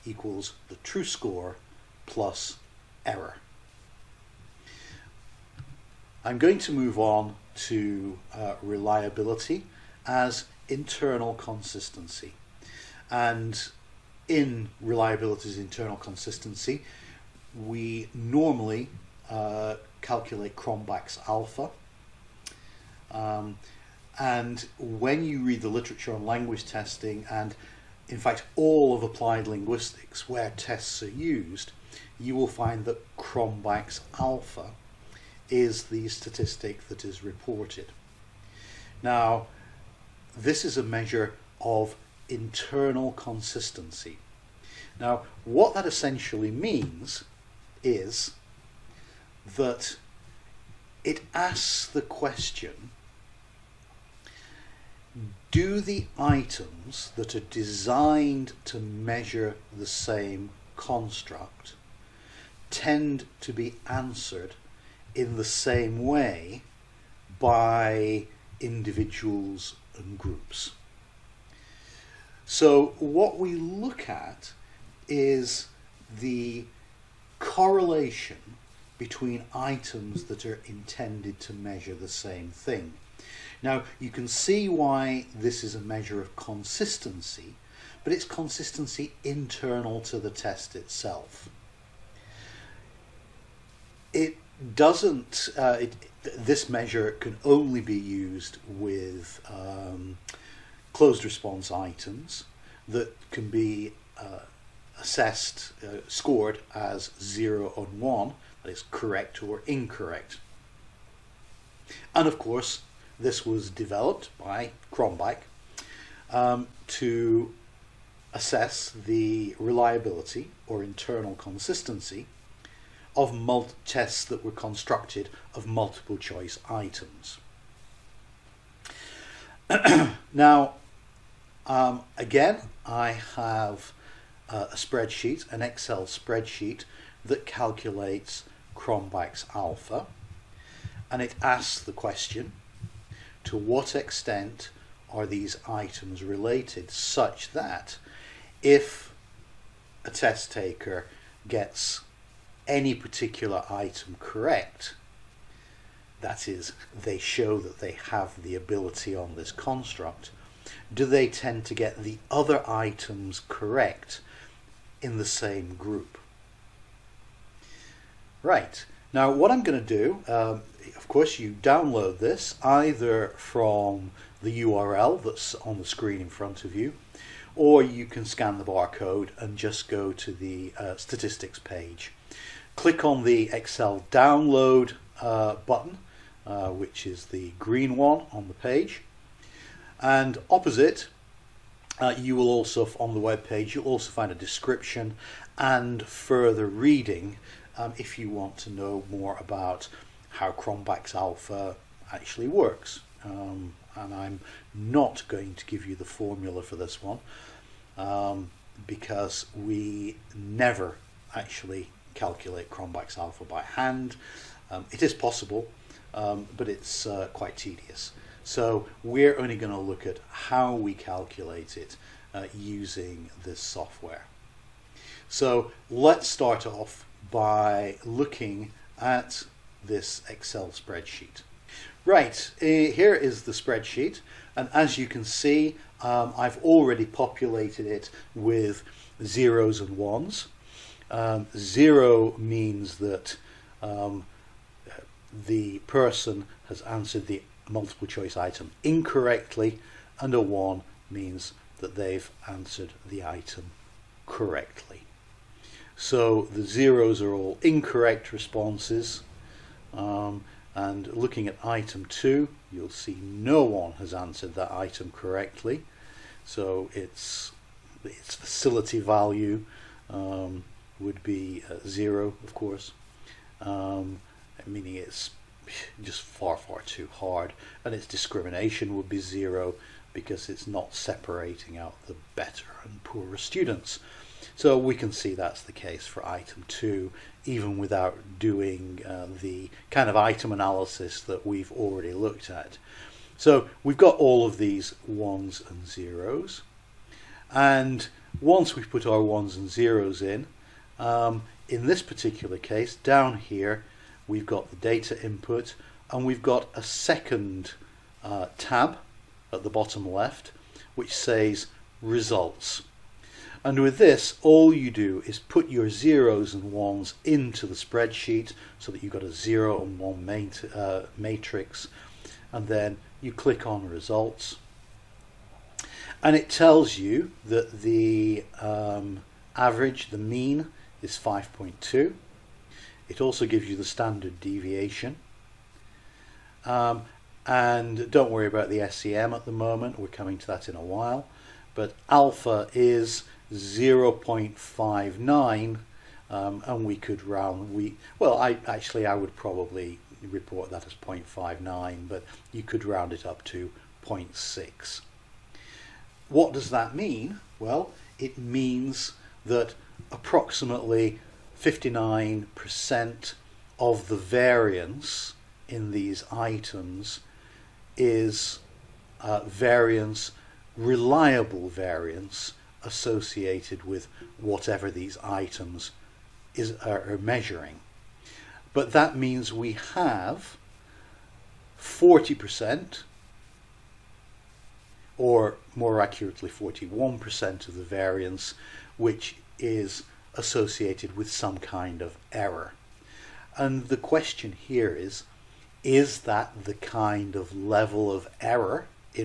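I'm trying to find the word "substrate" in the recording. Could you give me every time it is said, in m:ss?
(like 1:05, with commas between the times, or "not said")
not said.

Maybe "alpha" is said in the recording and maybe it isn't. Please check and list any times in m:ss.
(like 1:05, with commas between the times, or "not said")
0:21, 0:34, 2:19, 3:21, 3:33, 5:42.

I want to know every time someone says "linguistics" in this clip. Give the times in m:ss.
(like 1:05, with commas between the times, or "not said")
0:29.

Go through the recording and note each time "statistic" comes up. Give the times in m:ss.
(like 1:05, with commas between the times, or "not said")
0:36, 3:00.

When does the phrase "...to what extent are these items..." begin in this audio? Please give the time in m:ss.
2:23.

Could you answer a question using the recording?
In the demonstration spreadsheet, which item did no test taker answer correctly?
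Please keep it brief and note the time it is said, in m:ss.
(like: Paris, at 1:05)
Item 2, at 4:21.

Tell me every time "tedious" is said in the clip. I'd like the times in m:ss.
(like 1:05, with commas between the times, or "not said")
3:37.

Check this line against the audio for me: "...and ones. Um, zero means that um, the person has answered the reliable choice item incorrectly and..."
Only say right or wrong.
wrong.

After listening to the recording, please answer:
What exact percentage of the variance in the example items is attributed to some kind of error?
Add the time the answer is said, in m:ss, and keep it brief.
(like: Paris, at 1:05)
41%, at 6:26.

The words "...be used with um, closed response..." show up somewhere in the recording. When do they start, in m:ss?
1:37.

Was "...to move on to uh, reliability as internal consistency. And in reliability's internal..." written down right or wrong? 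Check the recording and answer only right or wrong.
right.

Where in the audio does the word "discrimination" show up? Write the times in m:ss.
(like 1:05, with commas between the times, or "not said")
4:38.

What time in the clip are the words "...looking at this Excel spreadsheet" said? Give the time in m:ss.
3:48.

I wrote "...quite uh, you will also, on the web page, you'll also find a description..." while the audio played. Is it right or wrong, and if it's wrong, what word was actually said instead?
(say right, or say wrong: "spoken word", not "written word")
wrong: "opposite", not "quite".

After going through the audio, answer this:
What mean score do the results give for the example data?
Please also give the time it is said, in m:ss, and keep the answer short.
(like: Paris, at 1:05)
5.2, at 5:31.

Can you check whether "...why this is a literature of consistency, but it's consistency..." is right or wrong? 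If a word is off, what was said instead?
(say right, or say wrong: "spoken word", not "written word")
wrong: "measure", not "literature".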